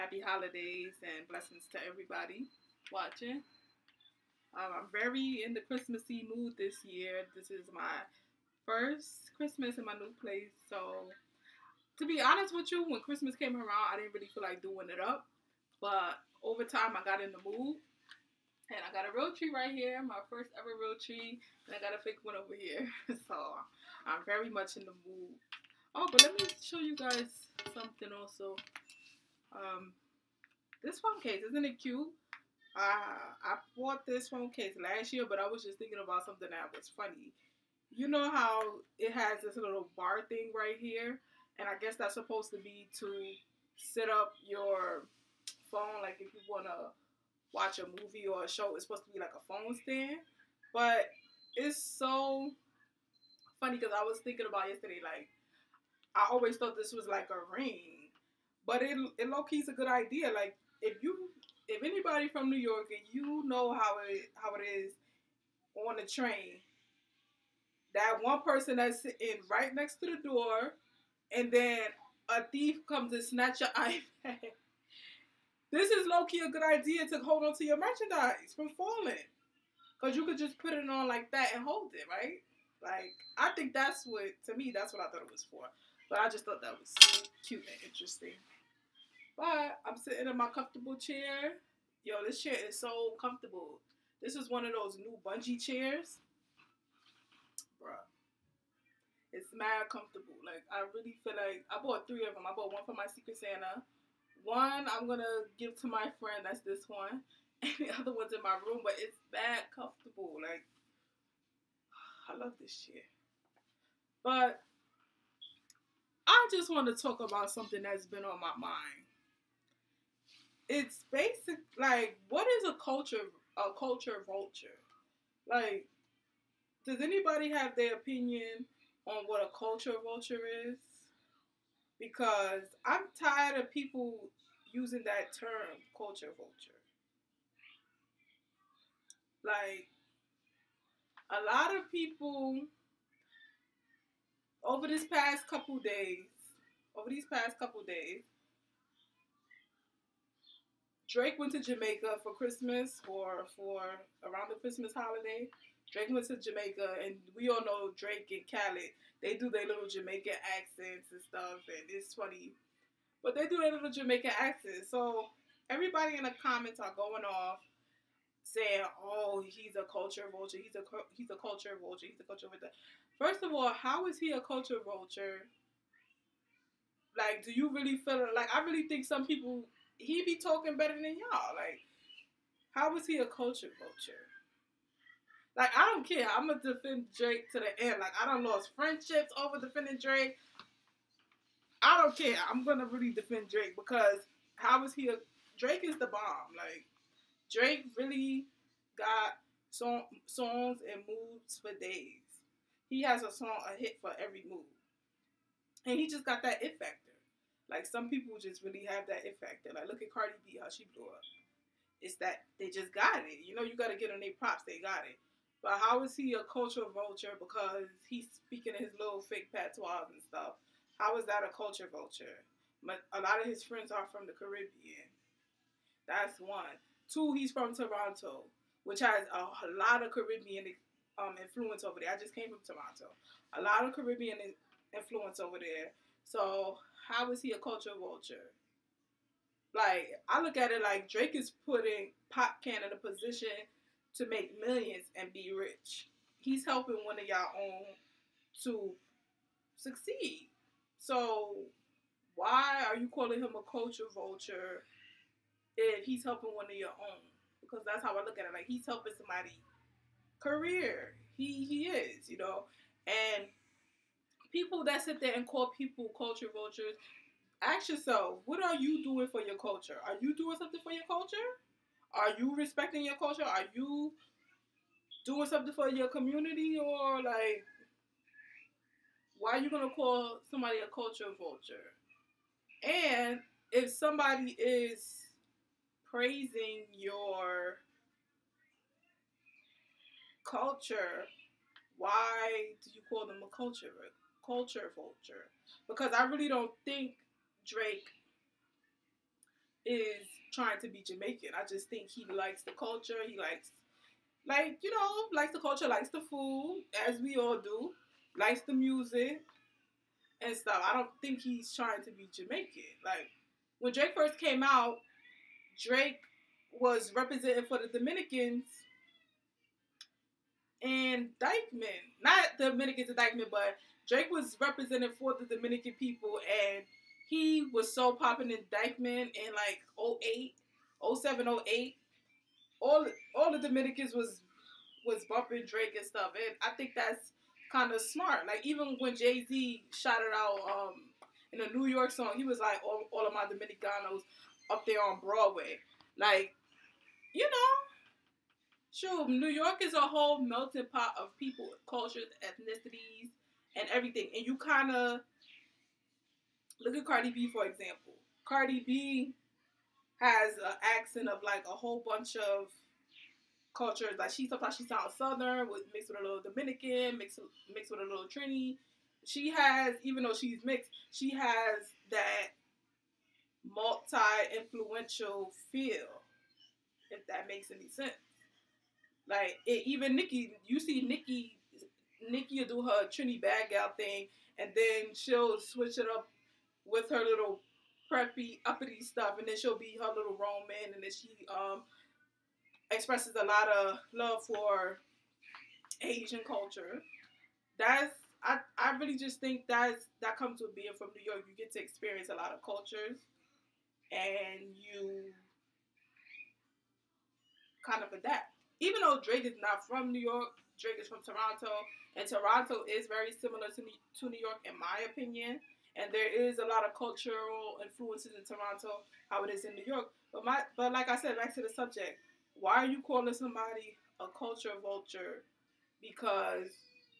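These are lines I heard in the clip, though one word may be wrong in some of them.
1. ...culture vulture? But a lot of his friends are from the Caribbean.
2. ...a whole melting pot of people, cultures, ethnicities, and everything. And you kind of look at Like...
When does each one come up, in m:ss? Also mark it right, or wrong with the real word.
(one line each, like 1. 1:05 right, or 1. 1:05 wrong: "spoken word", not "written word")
1. 3:41 right
2. 5:49 wrong: "Cardi", not "Like".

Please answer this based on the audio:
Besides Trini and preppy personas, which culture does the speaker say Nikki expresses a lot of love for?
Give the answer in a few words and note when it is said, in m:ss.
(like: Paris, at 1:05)
Asian culture, at 6:36.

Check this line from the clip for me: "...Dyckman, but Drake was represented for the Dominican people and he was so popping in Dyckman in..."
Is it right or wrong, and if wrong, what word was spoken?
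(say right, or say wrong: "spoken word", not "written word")
right.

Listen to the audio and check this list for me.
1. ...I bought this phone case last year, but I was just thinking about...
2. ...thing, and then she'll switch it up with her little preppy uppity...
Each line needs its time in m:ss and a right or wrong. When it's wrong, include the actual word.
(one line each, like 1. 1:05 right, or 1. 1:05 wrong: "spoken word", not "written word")
1. 0:33 right
2. 6:23 right.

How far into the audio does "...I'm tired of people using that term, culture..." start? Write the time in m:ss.
2:12.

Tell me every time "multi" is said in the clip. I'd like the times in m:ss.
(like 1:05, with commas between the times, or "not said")
6:13.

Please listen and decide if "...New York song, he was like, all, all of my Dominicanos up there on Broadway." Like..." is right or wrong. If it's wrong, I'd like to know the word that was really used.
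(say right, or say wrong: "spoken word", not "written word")
right.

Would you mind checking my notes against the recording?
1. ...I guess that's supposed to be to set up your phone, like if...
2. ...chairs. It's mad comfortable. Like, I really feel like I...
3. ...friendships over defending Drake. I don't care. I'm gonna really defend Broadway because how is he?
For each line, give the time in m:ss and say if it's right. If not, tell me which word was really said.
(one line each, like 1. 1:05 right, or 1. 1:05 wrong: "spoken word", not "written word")
1. 0:41 right
2. 1:35 right
3. 3:08 wrong: "Drake", not "Broadway".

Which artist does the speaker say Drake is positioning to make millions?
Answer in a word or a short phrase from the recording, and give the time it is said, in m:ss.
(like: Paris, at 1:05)
Popcaan, at 4:02.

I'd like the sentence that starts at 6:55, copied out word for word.
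And there is a lot of cultural influences in Toronto, how it is in New York.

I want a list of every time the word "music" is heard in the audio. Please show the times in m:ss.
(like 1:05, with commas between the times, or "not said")
5:08.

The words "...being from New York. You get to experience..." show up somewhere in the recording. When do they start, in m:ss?
6:40.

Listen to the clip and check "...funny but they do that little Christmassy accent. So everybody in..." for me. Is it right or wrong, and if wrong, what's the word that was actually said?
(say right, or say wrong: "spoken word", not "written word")
wrong: "Jamaican", not "Christmassy".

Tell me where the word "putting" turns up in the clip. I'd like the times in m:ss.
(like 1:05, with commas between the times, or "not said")
4:01.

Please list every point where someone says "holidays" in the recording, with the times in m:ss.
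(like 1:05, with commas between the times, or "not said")
0:00, 2:34.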